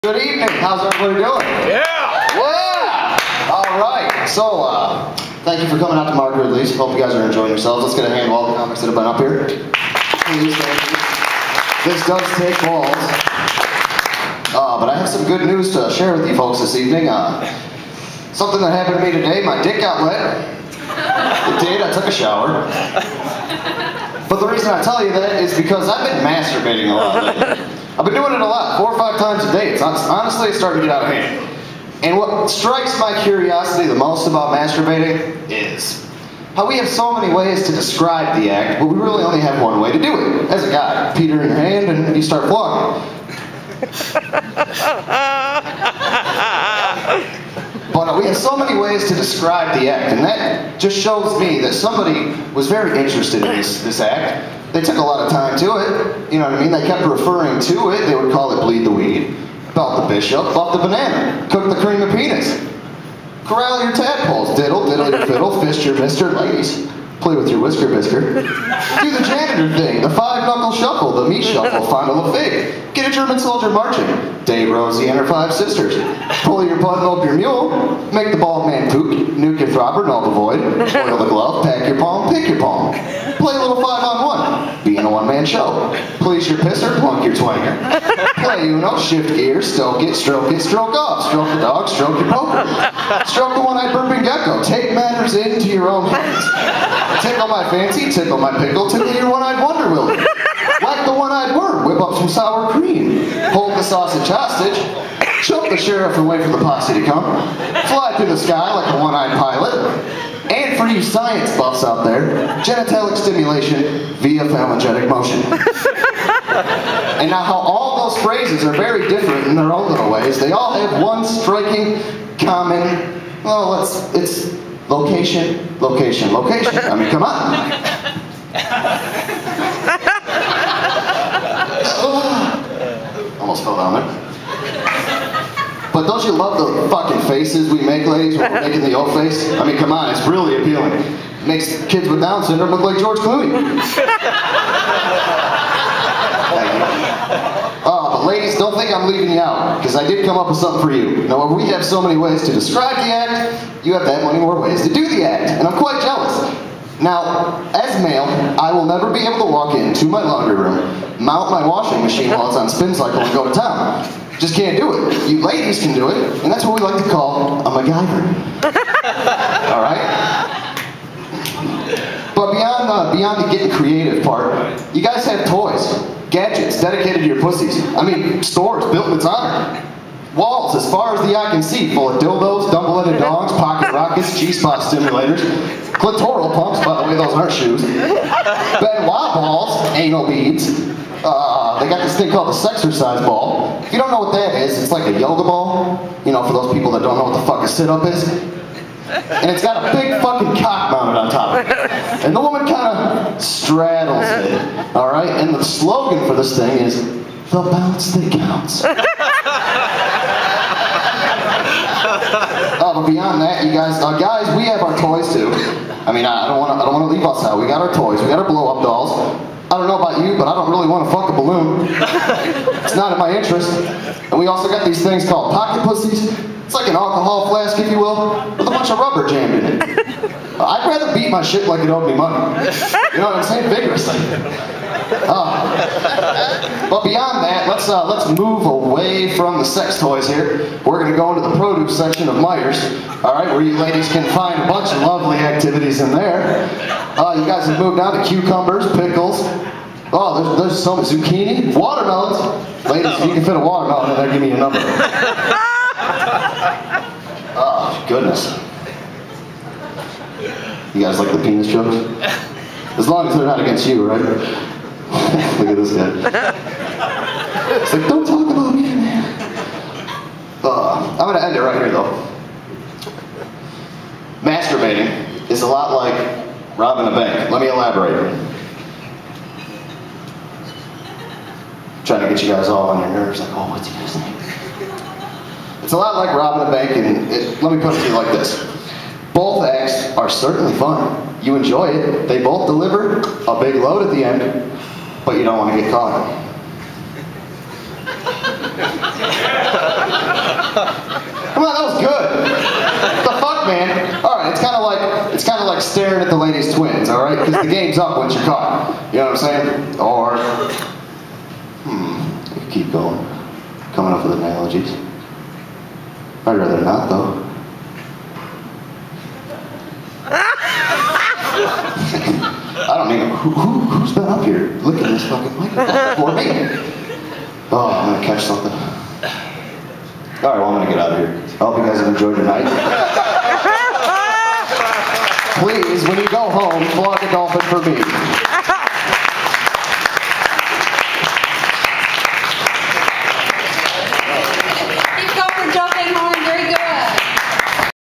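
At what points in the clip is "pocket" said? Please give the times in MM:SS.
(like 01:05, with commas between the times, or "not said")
03:03, 03:45.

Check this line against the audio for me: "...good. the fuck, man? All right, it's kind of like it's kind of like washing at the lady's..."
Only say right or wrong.
wrong.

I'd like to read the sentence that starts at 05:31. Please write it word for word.
I hope you guys have enjoyed tonight.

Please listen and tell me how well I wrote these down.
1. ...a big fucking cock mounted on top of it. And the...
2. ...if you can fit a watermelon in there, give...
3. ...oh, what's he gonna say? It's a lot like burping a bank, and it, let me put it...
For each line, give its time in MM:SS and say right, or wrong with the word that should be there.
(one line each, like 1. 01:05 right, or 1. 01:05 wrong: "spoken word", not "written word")
1. 03:19 right
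2. 04:13 right
3. 04:43 wrong: "robbing", not "burping".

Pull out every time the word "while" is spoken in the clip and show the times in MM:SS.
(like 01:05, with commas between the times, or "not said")
02:42.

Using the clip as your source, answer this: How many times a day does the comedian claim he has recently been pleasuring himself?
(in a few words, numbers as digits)
4 or 5.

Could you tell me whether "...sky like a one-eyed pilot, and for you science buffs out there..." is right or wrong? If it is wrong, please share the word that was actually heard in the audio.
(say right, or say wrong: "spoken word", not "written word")
right.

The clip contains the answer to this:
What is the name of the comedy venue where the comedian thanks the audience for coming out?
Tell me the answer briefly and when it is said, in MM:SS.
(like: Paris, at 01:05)
Mark Ridley's, at 00:06.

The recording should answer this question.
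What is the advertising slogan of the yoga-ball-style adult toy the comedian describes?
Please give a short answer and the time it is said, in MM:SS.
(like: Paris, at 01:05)
The bounce that counts, at 03:27.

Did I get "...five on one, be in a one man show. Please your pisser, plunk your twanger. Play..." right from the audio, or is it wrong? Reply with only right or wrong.
right.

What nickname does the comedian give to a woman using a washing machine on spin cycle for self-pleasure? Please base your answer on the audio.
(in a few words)
A MacGyver.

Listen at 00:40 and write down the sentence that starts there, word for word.
As a guy, Peter in your hand, and you start flogging.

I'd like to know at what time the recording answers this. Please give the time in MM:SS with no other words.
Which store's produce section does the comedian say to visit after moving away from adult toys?
04:02.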